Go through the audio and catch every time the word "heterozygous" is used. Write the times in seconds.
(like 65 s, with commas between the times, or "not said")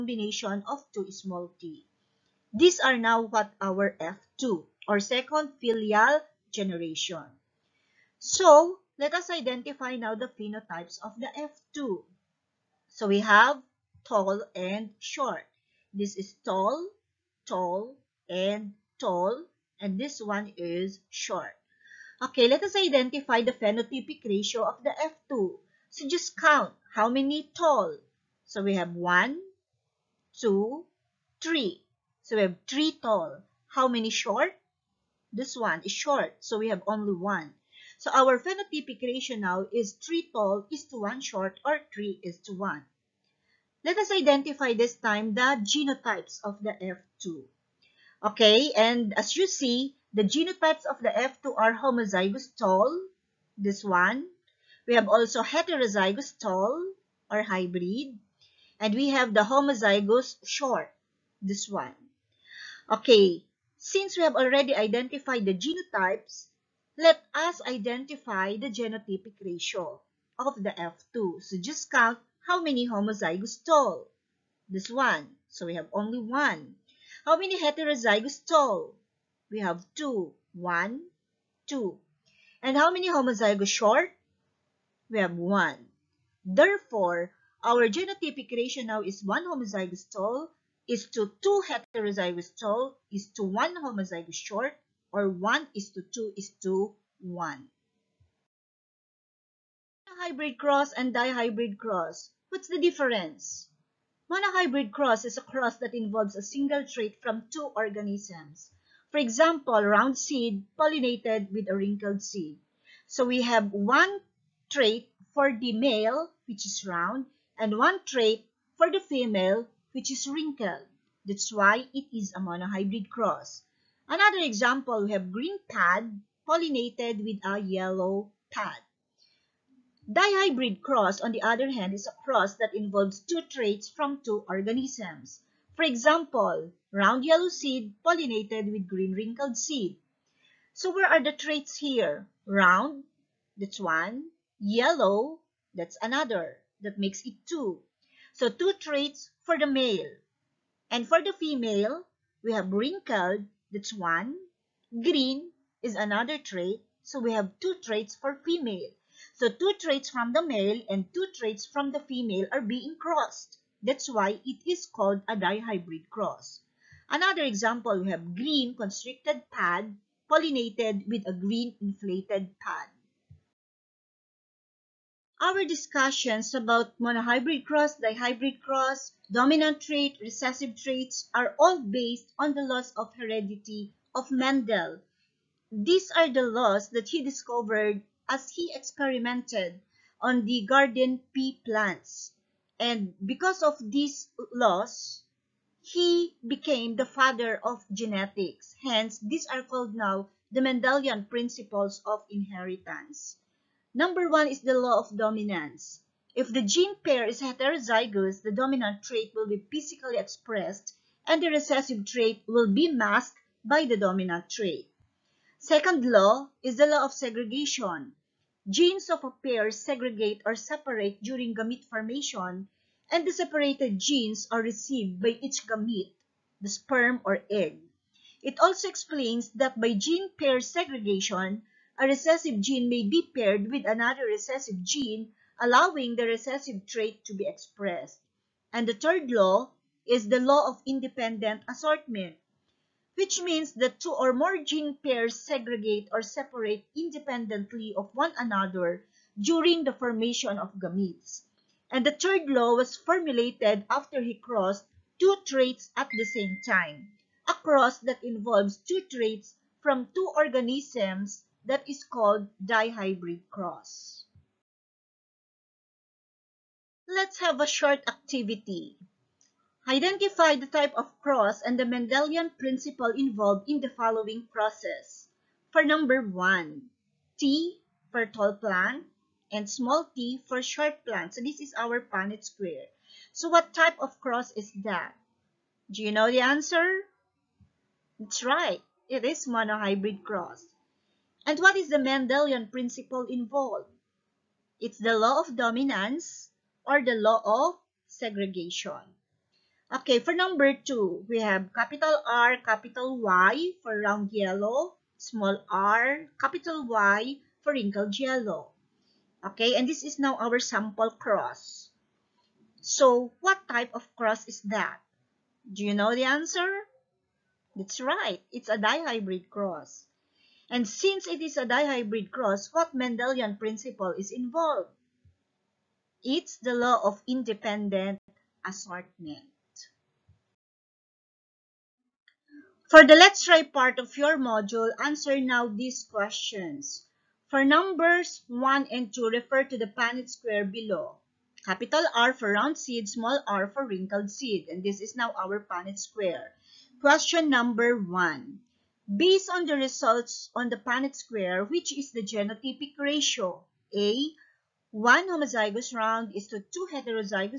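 55 s, 77 s, 91 s, 207 s, 356 s.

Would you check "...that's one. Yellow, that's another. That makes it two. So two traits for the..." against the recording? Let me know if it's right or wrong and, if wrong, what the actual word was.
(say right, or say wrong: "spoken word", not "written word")
right.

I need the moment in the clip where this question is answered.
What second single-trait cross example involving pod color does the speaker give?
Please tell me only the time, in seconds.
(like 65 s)
125 s.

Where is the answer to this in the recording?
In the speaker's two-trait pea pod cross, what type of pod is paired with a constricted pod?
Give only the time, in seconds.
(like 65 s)
171 s.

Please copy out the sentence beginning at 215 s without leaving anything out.
Second law is the law of segregation.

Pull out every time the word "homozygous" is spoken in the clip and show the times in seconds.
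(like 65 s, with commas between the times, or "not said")
51 s, 59 s, 72 s, 83 s, 89 s, 93 s, 355 s.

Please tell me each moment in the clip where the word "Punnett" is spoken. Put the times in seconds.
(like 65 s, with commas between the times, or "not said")
282 s, 339 s, 345 s, 350 s.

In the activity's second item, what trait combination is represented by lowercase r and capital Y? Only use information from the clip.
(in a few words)
wrinkled yellow.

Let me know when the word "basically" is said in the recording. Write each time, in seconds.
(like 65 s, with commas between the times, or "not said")
not said.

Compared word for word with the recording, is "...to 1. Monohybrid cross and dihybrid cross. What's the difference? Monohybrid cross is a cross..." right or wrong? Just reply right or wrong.
right.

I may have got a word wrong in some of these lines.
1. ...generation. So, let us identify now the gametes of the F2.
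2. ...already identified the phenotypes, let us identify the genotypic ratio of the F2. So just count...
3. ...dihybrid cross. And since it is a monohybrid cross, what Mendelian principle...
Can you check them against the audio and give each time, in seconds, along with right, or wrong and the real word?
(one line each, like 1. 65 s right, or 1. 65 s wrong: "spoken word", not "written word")
1. 6 s wrong: "phenotypes", not "gametes"
2. 64 s wrong: "genotypes", not "phenotypes"
3. 318 s wrong: "dihybrid", not "monohybrid".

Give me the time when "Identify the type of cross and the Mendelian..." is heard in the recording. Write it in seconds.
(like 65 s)
269 s.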